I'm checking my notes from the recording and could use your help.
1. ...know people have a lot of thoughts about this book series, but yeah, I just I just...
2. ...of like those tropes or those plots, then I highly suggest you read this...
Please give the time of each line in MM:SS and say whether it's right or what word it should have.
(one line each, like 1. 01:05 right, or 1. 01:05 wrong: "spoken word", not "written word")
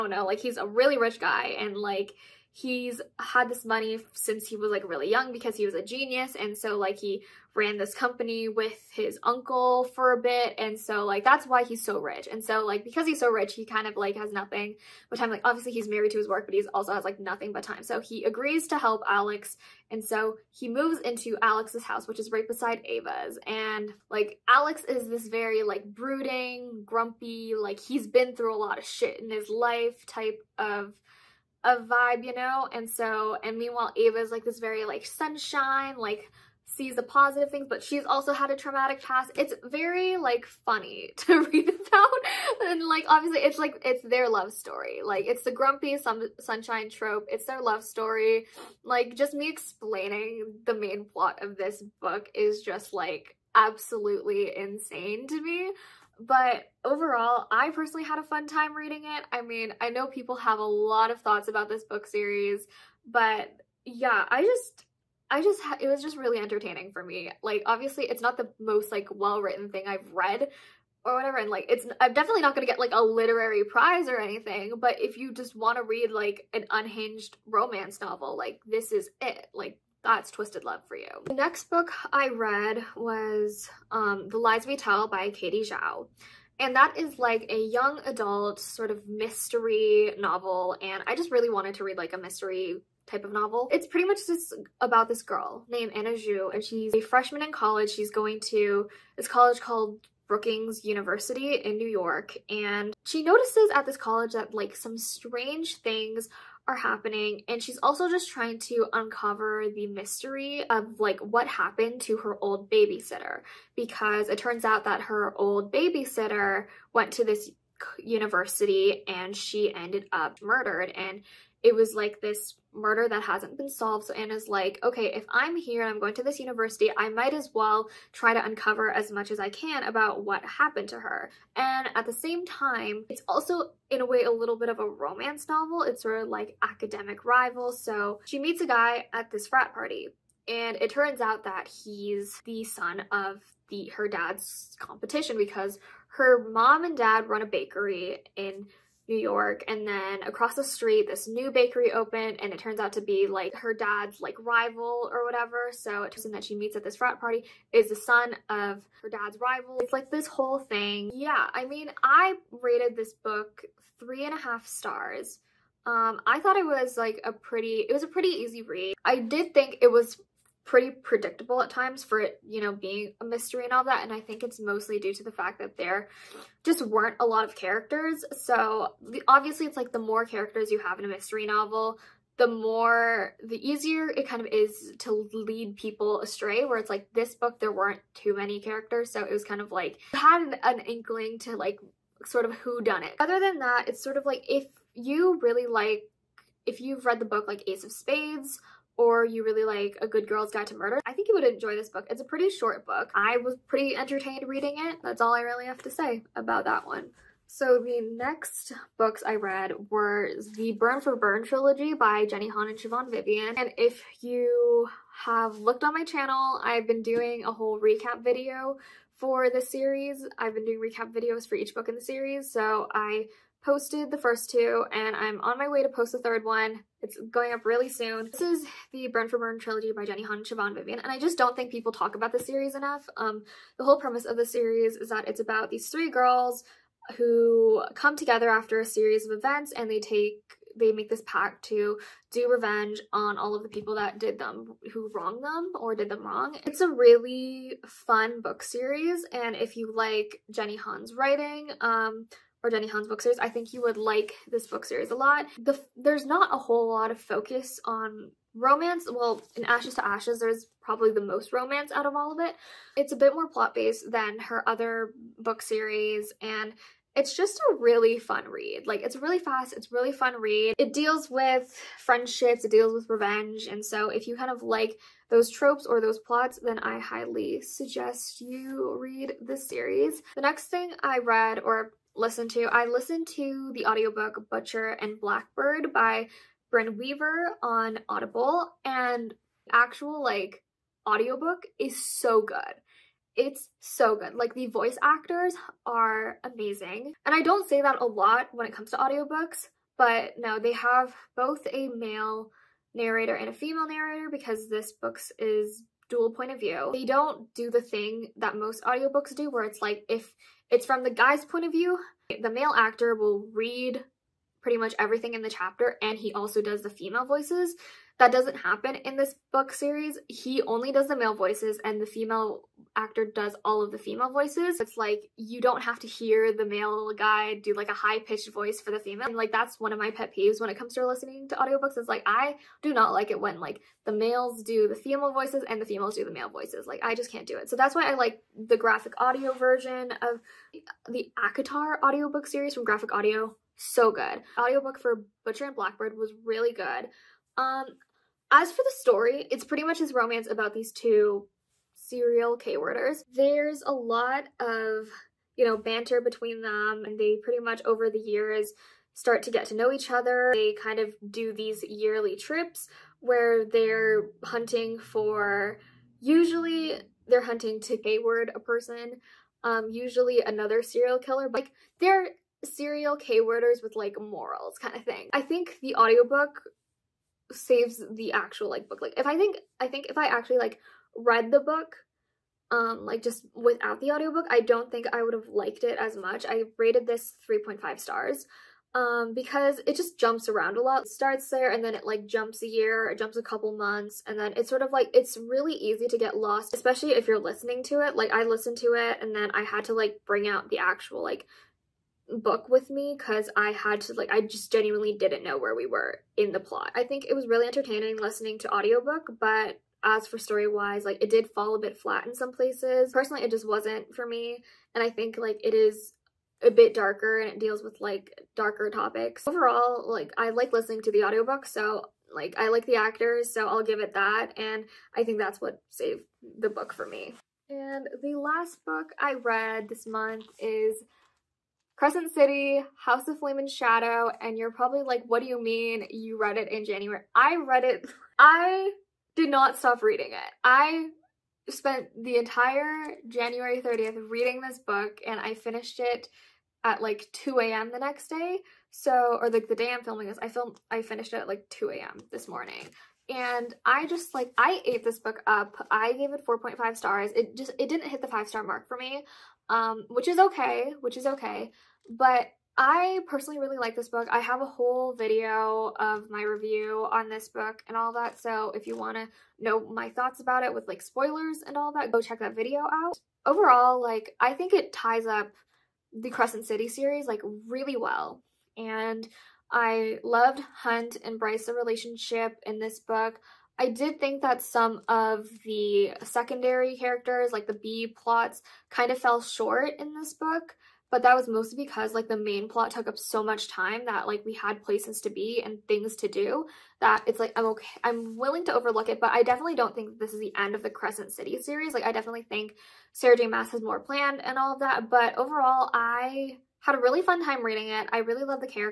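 1. 00:59 right
2. 04:34 right.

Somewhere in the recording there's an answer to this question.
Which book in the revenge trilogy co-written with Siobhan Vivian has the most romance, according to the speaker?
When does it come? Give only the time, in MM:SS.
04:19.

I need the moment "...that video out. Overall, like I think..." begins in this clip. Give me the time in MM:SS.
07:52.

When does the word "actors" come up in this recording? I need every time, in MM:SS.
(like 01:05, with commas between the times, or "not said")
04:55, 05:12, 05:22, 07:02.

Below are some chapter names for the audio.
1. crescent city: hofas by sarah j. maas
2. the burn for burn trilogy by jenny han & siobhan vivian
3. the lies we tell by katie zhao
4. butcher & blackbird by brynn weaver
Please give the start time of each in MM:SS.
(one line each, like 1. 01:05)
1. 07:07
2. 03:27
3. 01:20
4. 04:39.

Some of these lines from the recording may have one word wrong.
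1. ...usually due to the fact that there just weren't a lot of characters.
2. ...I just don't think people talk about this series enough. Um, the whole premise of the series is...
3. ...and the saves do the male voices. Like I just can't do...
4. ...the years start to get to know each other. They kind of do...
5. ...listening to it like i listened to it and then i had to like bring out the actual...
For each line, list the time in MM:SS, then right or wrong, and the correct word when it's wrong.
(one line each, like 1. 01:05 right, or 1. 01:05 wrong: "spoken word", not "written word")
1. 02:54 wrong: "mostly", not "usually"
2. 03:51 right
3. 05:35 wrong: "females", not "saves"
4. 05:58 right
5. 06:37 right.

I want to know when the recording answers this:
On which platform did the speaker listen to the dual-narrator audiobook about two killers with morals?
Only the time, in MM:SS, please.
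04:48.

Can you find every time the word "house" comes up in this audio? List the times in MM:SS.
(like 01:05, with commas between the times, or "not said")
00:21, 07:12.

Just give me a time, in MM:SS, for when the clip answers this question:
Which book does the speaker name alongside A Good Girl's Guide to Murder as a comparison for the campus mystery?
03:17.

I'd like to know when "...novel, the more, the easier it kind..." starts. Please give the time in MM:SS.
03:01.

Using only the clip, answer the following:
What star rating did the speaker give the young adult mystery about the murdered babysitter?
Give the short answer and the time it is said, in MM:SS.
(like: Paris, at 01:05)
3.5 stars, at 02:43.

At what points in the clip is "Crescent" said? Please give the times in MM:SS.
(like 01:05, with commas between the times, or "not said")
07:11, 07:56, 08:20.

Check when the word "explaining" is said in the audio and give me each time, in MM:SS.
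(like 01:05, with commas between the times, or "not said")
00:49.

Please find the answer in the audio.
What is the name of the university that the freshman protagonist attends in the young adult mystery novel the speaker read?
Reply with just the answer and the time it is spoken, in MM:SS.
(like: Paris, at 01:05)
Brookings University, at 01:40.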